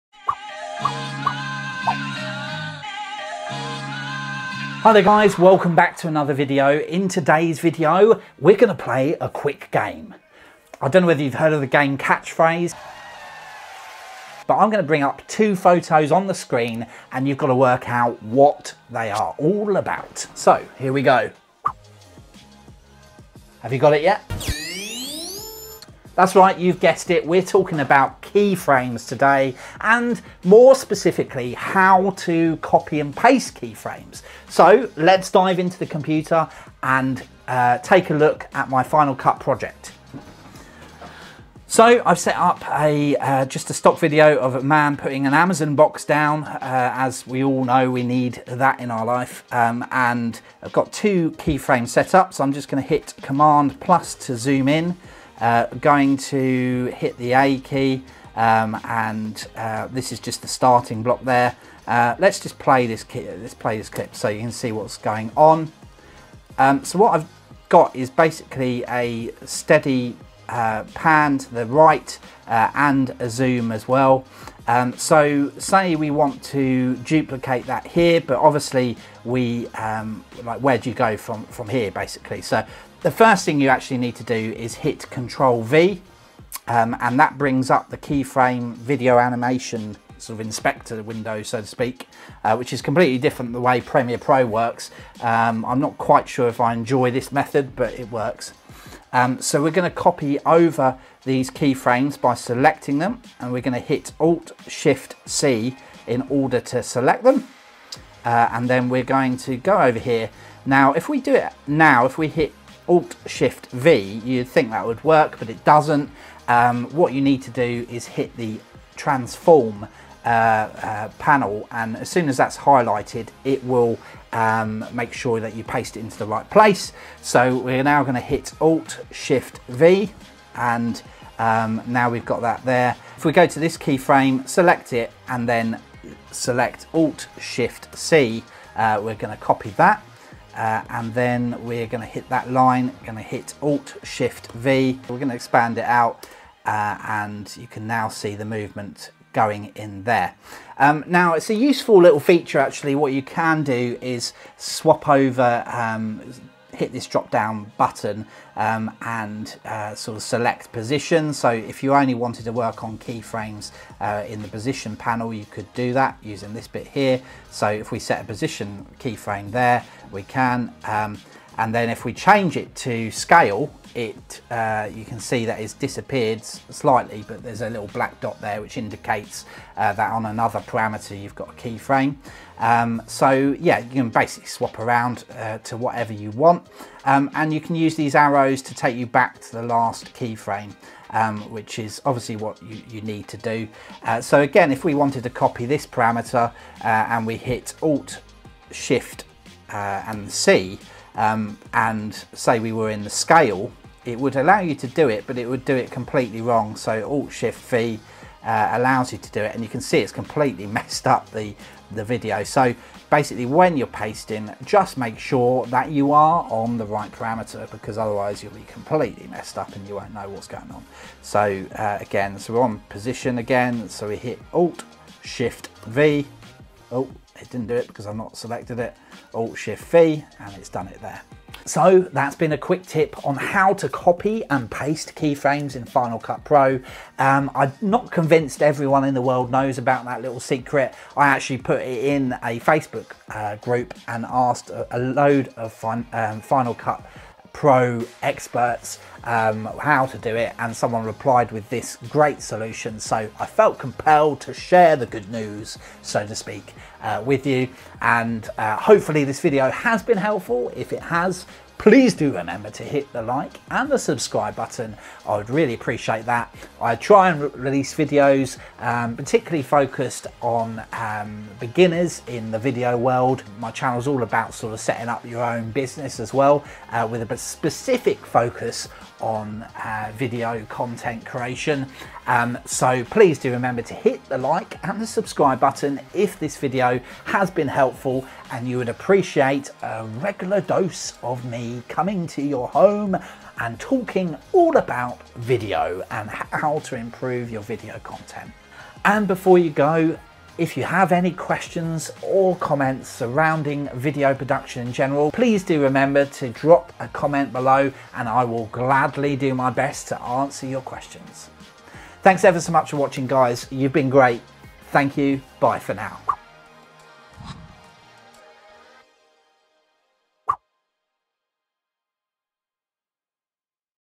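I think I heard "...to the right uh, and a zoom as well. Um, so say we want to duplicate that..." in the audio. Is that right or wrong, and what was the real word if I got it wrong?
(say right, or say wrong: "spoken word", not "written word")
right.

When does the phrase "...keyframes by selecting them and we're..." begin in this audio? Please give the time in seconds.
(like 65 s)
101 s.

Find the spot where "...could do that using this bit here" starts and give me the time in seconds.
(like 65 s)
165 s.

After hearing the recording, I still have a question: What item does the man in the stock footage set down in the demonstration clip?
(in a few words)
Amazon box.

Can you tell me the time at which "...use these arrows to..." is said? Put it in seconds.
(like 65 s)
187 s.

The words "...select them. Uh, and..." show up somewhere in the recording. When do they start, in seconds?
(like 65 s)
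106 s.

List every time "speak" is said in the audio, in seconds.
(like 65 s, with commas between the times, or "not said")
91 s, 256 s.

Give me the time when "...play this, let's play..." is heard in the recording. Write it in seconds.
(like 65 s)
62 s.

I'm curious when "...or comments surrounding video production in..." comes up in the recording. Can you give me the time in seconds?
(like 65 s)
302 s.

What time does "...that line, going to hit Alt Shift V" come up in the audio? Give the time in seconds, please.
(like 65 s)
142 s.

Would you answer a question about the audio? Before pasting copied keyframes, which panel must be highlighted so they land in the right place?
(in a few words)
Transform.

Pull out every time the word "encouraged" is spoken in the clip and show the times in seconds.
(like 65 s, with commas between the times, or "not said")
not said.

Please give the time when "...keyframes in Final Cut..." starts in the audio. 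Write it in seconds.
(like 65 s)
235 s.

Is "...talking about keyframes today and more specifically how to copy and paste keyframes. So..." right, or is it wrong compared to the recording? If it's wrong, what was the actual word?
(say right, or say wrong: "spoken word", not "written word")
right.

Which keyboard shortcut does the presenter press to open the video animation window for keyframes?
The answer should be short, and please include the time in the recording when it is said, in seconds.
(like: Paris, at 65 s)
Control V, at 85 s.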